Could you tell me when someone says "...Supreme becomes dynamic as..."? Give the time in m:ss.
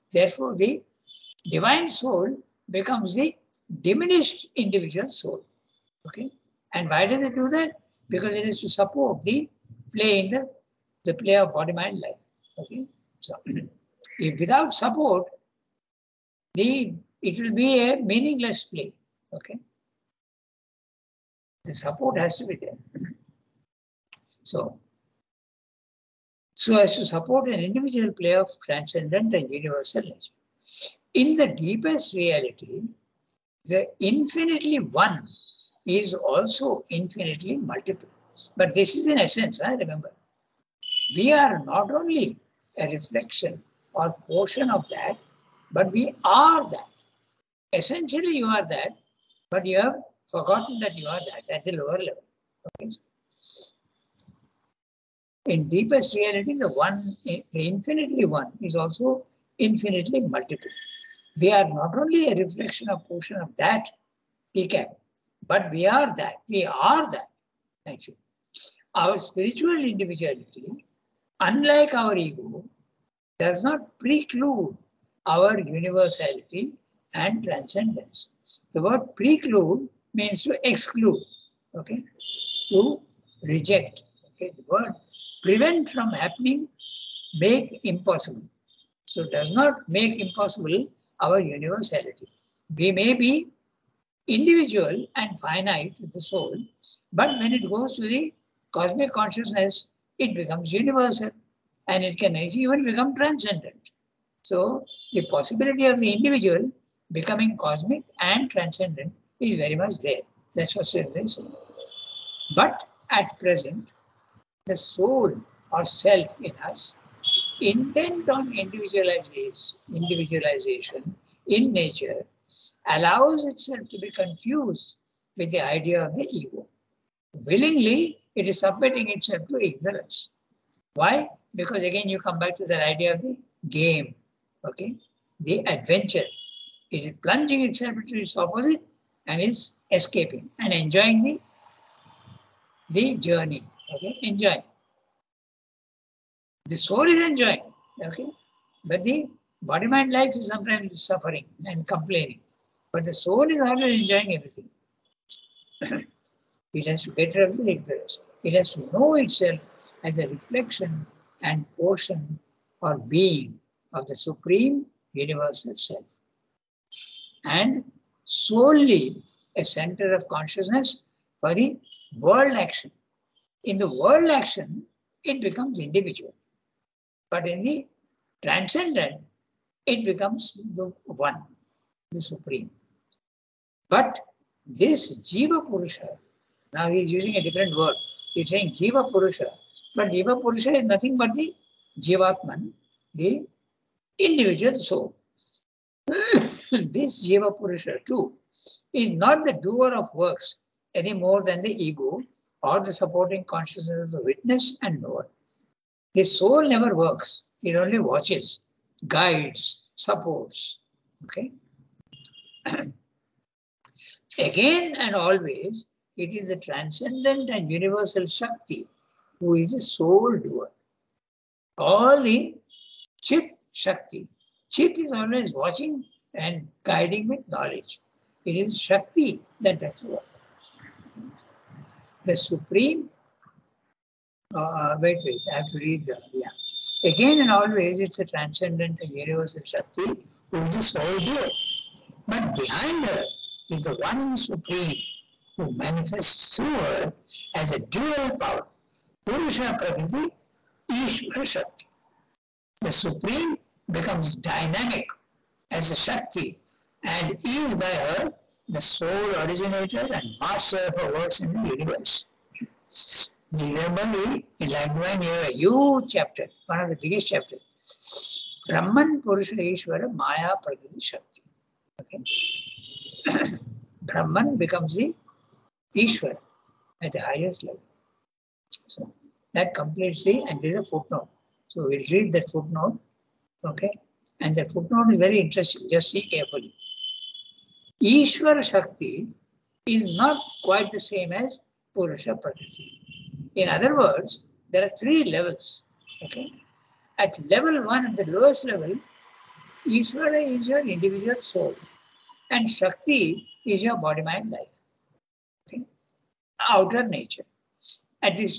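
4:12.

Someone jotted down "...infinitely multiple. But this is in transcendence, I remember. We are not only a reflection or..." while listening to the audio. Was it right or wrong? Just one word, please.
wrong.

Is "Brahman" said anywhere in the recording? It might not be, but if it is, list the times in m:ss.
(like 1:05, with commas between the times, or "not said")
4:28, 4:34.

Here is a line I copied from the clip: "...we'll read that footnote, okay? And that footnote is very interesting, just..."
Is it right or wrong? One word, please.
right.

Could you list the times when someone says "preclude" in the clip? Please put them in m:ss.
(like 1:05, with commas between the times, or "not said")
1:14, 1:19.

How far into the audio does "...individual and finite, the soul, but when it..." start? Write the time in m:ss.
1:34.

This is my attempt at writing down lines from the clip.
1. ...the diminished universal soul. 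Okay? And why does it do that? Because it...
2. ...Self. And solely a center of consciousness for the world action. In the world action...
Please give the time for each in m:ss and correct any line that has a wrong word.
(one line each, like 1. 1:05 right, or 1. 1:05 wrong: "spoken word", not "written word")
1. 0:03 wrong: "individual", not "universal"
2. 2:45 right.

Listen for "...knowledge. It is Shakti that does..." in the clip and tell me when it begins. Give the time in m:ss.
3:47.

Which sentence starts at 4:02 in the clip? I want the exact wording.
But behind her is the one Supreme who manifests through her as a dual power.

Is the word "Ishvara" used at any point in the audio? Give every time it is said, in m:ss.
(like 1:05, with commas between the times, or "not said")
4:10, 4:29.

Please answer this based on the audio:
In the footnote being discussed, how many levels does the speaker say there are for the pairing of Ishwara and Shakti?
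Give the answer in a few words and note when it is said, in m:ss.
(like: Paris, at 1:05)
3, at 4:54.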